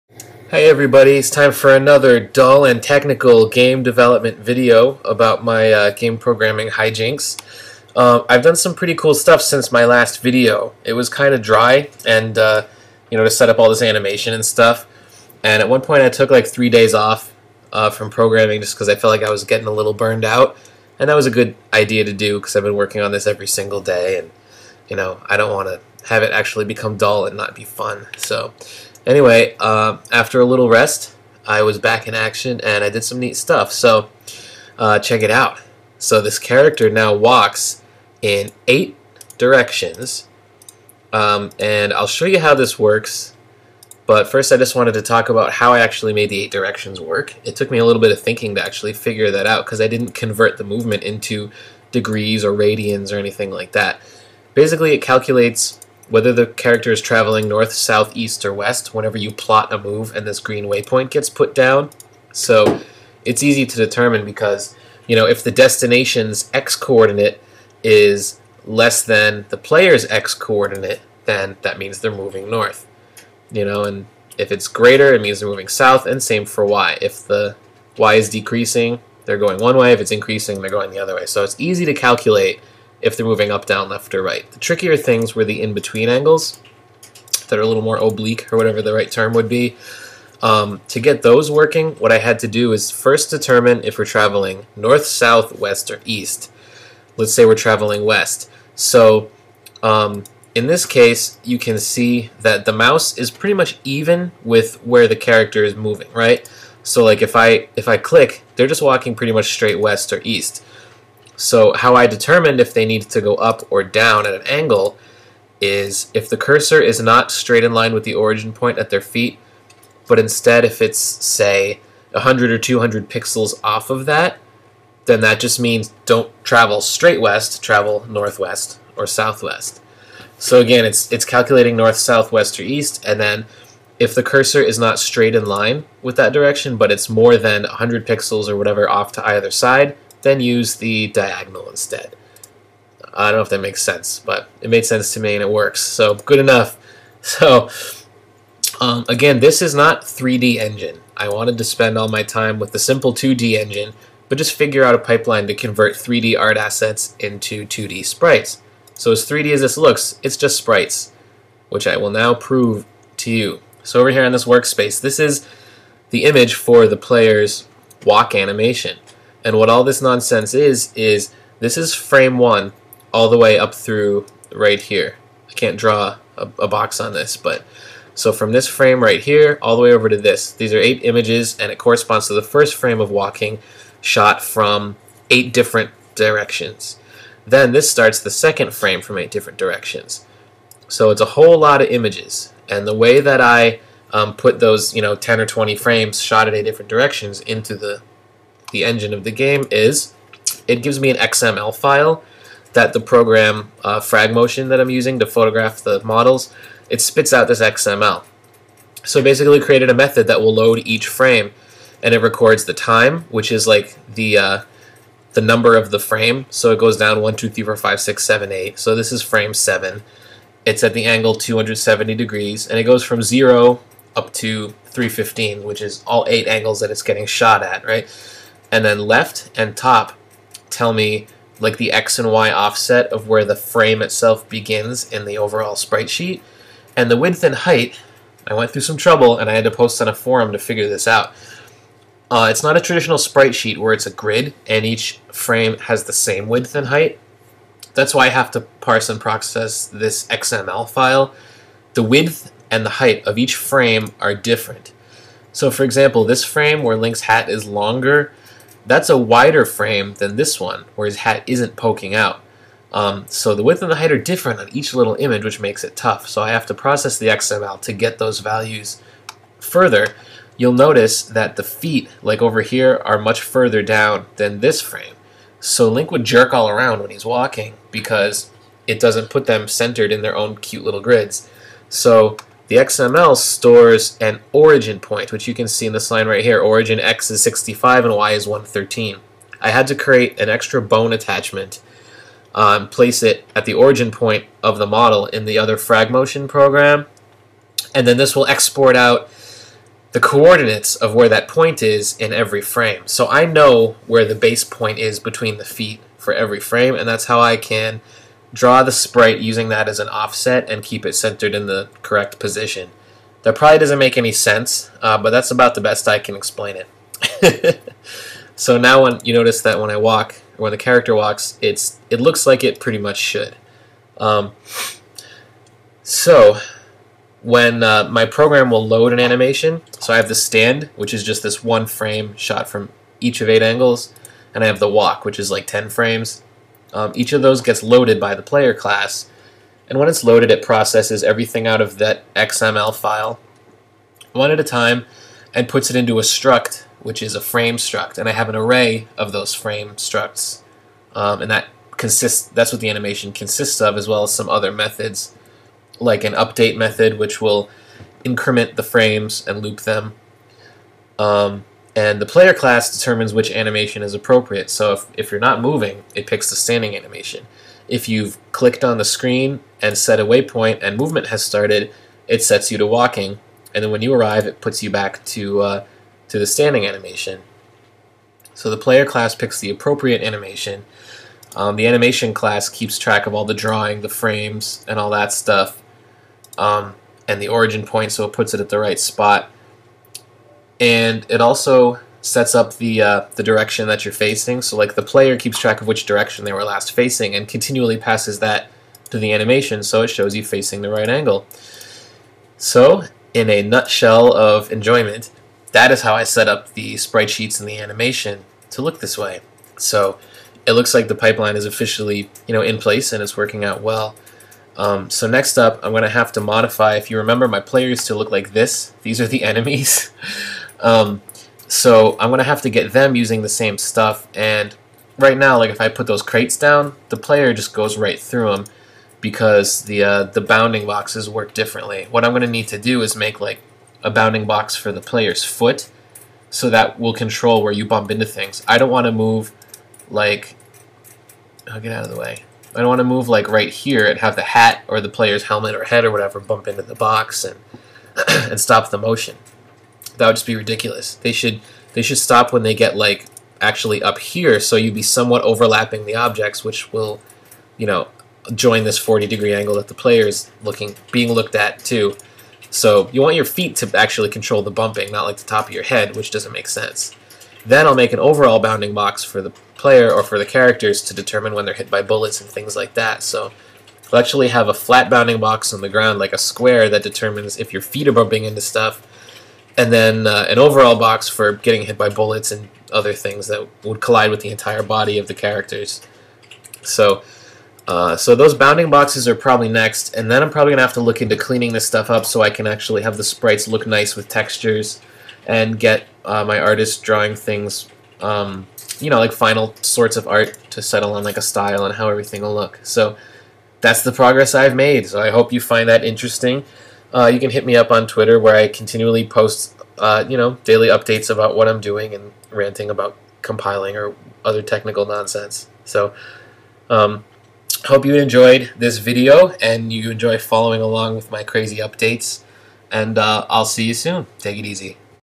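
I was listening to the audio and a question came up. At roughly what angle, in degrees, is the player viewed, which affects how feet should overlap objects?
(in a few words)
40.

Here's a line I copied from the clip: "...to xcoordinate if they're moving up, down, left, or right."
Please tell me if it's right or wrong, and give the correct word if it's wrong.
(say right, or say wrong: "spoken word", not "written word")
wrong: "calculate", not "xcoordinate".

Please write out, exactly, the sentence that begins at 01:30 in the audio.
Um, to get those working, what I had to do is first determine if we're traveling north, south, west, or east.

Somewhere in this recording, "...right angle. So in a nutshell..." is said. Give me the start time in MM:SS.
06:40.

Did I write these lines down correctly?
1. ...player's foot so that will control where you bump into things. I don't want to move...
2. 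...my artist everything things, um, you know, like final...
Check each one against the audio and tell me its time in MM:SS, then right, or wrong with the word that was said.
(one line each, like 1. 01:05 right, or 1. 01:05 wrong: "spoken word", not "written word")
1. 07:14 right
2. 08:16 wrong: "drawing", not "everything".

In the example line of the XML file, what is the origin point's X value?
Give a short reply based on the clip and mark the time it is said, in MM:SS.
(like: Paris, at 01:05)
65, at 04:47.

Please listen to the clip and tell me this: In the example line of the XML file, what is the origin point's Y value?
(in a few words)
113.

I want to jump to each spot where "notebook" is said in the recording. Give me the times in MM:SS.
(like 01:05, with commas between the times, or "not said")
not said.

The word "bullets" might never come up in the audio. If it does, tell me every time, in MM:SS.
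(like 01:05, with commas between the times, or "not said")
07:52, 08:02.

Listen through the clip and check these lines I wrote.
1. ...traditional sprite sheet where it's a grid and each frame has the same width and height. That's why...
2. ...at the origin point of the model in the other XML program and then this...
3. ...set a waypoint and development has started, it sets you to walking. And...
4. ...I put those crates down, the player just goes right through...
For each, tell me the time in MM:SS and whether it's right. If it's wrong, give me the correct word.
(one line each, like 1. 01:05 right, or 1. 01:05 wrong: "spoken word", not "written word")
1. 04:02 right
2. 04:53 wrong: "FragMotion", not "XML"
3. 06:09 wrong: "movement", not "development"
4. 07:05 right.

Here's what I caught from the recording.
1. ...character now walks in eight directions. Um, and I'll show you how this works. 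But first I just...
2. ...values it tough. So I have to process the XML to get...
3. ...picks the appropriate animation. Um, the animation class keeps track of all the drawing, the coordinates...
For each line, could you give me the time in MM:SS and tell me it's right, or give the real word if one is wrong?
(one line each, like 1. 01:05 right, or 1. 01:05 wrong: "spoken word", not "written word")
1. 00:36 right
2. 04:25 wrong: "makes", not "values"
3. 06:19 wrong: "frames", not "coordinates".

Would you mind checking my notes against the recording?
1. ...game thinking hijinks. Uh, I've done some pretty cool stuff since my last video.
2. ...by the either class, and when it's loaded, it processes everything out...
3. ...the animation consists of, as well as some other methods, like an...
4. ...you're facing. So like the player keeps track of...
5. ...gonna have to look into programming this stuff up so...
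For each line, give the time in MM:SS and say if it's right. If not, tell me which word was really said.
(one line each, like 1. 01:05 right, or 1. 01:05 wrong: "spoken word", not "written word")
1. 00:05 wrong: "programming", not "thinking"
2. 05:38 wrong: "player", not "either"
3. 05:52 right
4. 06:34 right
5. 08:10 wrong: "cleaning", not "programming".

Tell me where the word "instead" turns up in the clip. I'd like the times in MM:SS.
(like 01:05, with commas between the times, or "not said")
02:00, 02:21.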